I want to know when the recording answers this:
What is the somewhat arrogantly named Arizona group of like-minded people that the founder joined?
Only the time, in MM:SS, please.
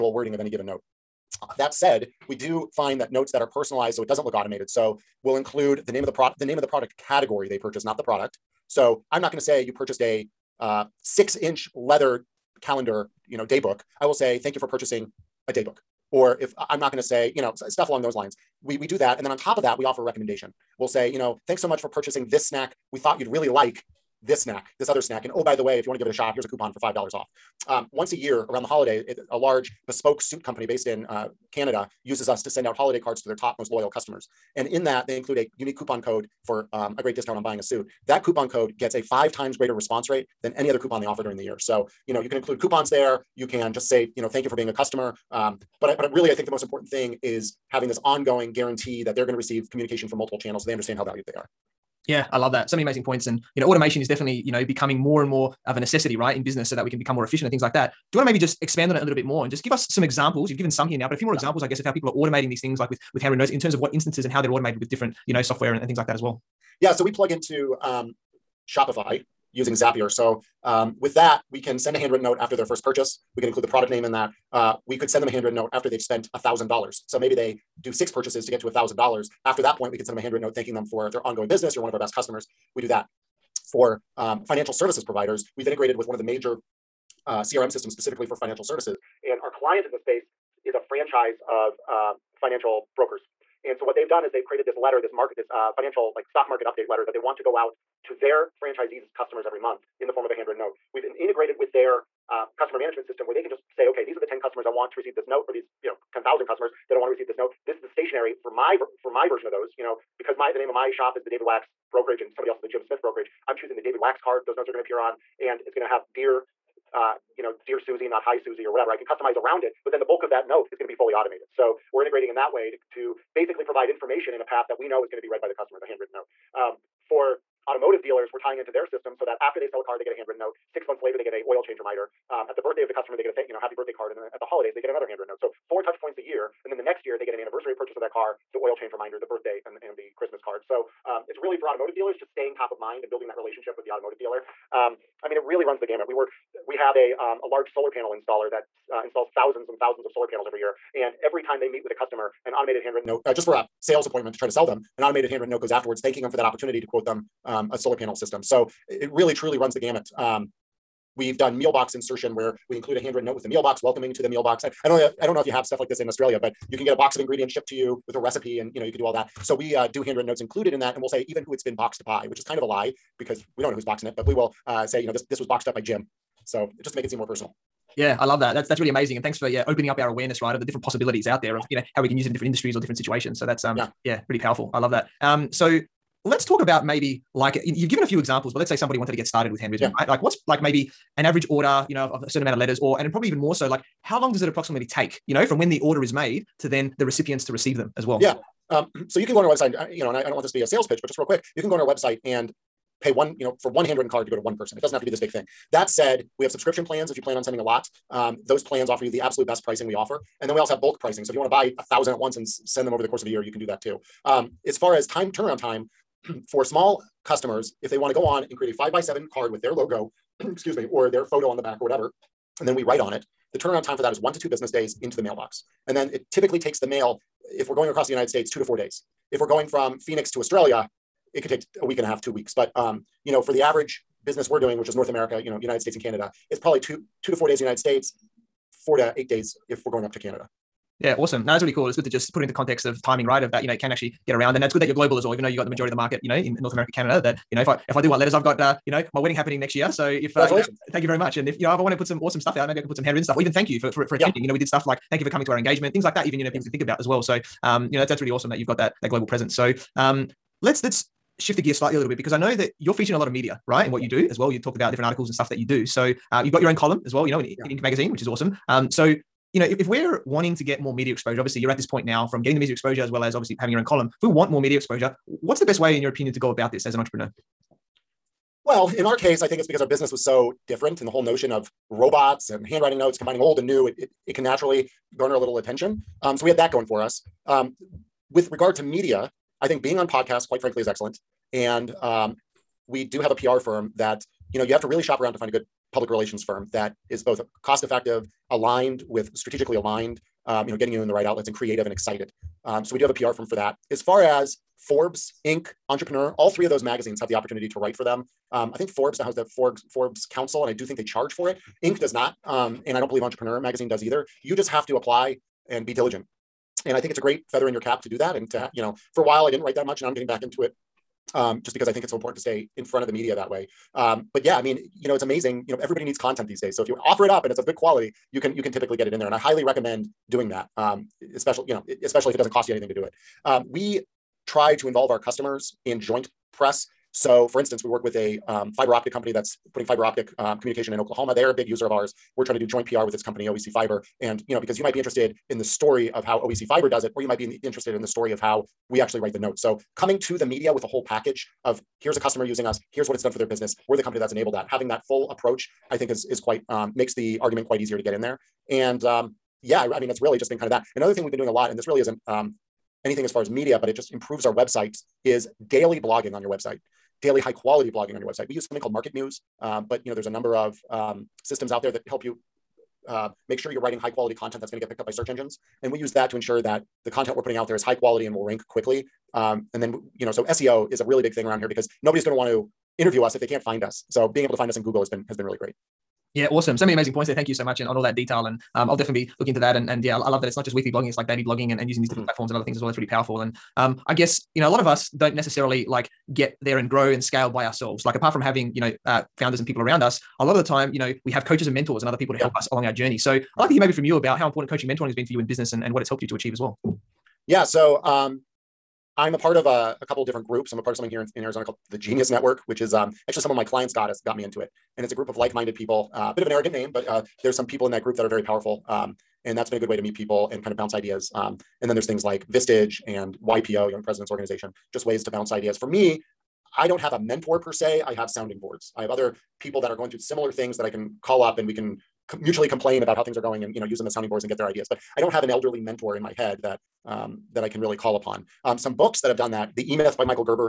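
06:51.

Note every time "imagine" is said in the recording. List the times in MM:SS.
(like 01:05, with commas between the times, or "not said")
not said.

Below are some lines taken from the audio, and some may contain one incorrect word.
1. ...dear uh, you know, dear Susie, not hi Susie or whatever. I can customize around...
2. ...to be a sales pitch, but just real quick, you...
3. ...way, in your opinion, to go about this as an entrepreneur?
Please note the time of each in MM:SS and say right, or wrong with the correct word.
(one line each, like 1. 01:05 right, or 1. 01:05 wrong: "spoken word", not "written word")
1. 01:56 right
2. 03:20 right
3. 04:35 right.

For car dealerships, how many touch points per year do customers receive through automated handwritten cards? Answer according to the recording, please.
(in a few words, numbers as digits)
4.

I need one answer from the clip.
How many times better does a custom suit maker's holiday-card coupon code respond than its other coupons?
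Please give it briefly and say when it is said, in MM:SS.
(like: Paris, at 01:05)
5 times, at 00:39.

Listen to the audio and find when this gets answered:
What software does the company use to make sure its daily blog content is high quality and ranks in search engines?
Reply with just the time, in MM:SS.
06:08.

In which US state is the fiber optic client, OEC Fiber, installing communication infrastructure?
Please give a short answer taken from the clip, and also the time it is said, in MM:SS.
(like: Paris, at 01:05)
Oklahoma, at 05:40.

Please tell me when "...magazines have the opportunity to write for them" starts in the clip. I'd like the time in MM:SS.
05:06.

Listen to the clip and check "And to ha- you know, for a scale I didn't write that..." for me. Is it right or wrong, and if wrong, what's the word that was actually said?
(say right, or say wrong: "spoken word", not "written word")
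wrong: "while", not "scale".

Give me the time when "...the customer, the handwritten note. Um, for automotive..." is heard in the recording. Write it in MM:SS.
02:05.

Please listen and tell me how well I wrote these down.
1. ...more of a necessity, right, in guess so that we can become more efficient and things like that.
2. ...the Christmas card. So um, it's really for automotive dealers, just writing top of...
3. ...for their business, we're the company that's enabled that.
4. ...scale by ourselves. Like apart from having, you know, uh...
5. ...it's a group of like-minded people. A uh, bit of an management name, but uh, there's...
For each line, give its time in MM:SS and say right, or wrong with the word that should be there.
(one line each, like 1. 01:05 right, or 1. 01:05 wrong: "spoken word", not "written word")
1. 00:55 wrong: "business", not "guess"
2. 02:19 wrong: "staying", not "writing"
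3. 05:53 right
4. 06:37 right
5. 06:55 wrong: "arrogant", not "management".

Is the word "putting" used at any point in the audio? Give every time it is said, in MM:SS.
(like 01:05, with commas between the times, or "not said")
05:39, 06:17.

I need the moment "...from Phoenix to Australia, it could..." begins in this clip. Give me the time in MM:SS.
03:49.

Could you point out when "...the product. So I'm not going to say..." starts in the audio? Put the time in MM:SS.
00:07.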